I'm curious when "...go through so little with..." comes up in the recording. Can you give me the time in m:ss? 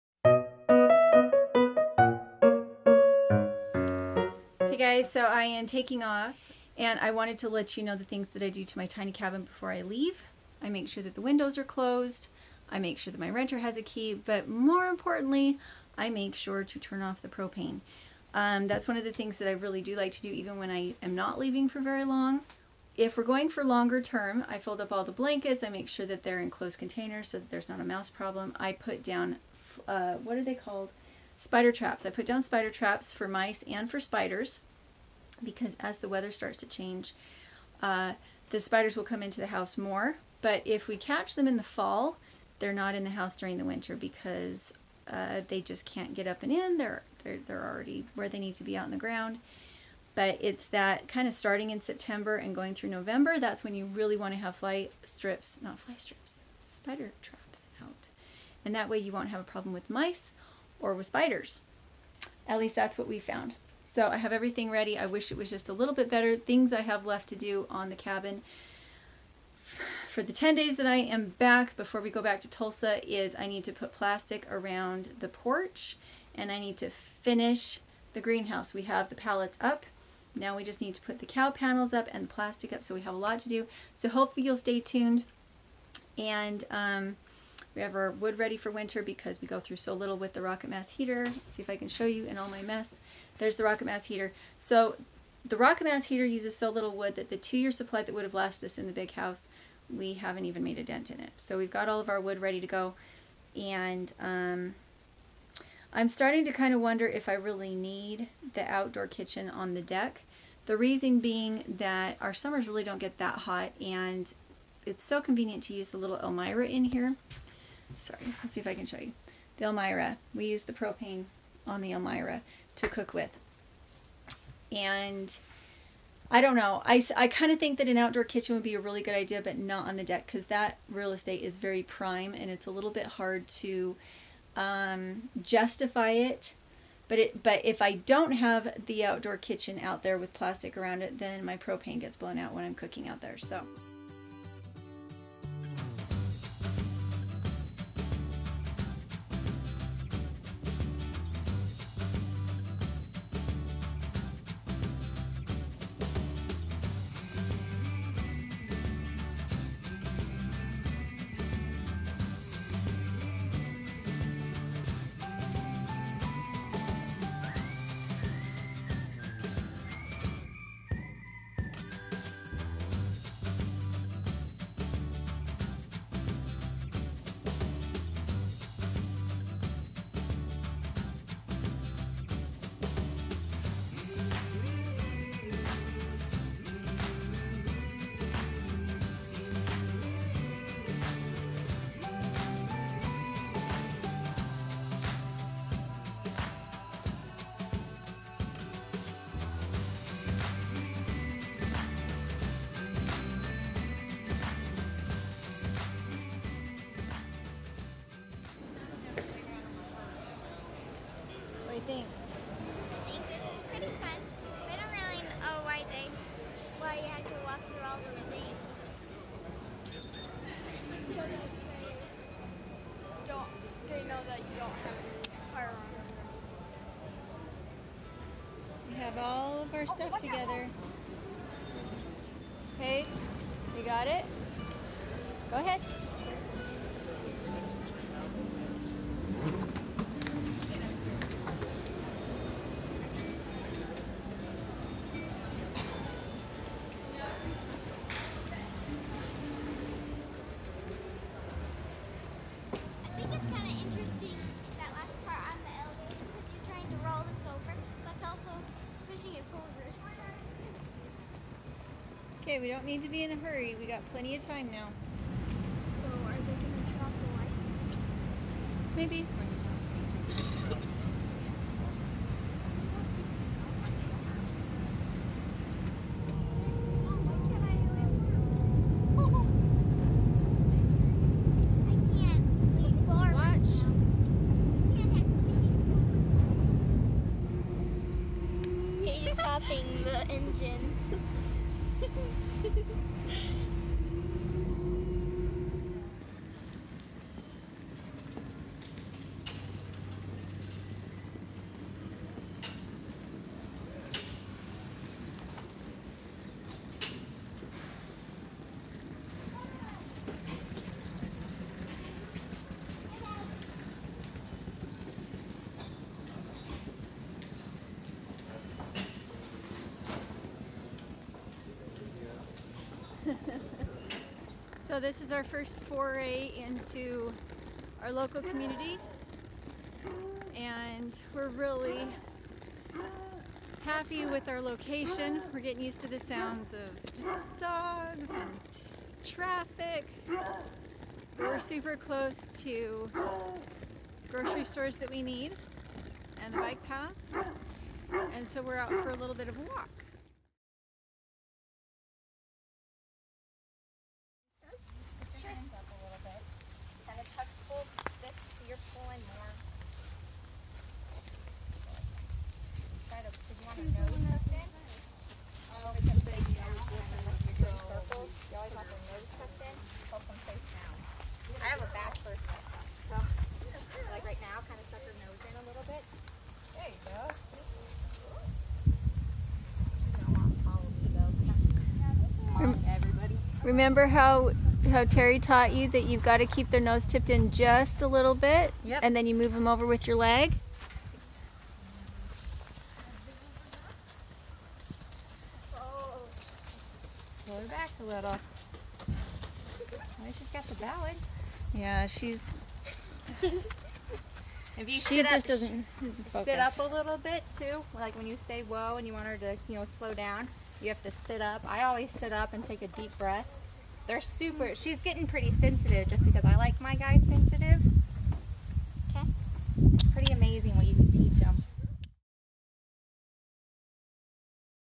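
1:29.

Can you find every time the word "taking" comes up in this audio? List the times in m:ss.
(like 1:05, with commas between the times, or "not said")
0:05.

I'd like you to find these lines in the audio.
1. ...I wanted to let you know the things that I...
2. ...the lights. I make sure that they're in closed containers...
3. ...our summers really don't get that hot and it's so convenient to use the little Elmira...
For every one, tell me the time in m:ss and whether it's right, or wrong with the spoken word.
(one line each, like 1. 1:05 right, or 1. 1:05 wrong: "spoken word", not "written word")
1. 0:07 right
2. 0:25 wrong: "blankets", not "lights"
3. 1:52 right.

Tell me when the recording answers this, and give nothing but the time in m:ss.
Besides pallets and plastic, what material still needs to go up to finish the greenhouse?
1:21.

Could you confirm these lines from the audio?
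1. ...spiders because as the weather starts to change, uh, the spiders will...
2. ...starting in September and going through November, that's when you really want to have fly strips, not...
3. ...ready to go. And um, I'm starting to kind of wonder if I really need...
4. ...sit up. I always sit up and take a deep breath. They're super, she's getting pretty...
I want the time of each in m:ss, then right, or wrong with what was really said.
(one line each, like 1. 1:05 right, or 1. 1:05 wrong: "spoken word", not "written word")
1. 0:33 right
2. 0:51 right
3. 1:42 right
4. 6:51 right.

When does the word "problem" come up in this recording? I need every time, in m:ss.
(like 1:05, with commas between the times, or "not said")
0:28, 0:59.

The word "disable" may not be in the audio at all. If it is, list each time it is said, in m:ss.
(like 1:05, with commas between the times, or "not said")
not said.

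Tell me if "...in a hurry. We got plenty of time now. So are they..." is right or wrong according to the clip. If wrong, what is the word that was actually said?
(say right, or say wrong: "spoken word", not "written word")
right.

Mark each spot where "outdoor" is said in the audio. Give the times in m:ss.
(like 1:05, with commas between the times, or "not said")
1:48, 2:07, 2:19.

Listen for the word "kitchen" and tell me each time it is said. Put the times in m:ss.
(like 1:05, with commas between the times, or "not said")
1:49, 2:08, 2:19.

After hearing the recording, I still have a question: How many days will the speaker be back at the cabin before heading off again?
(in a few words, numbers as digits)
10.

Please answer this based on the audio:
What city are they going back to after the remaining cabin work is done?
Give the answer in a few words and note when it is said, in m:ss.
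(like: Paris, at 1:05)
Tulsa, at 1:12.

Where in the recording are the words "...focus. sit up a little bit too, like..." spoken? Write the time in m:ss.
6:45.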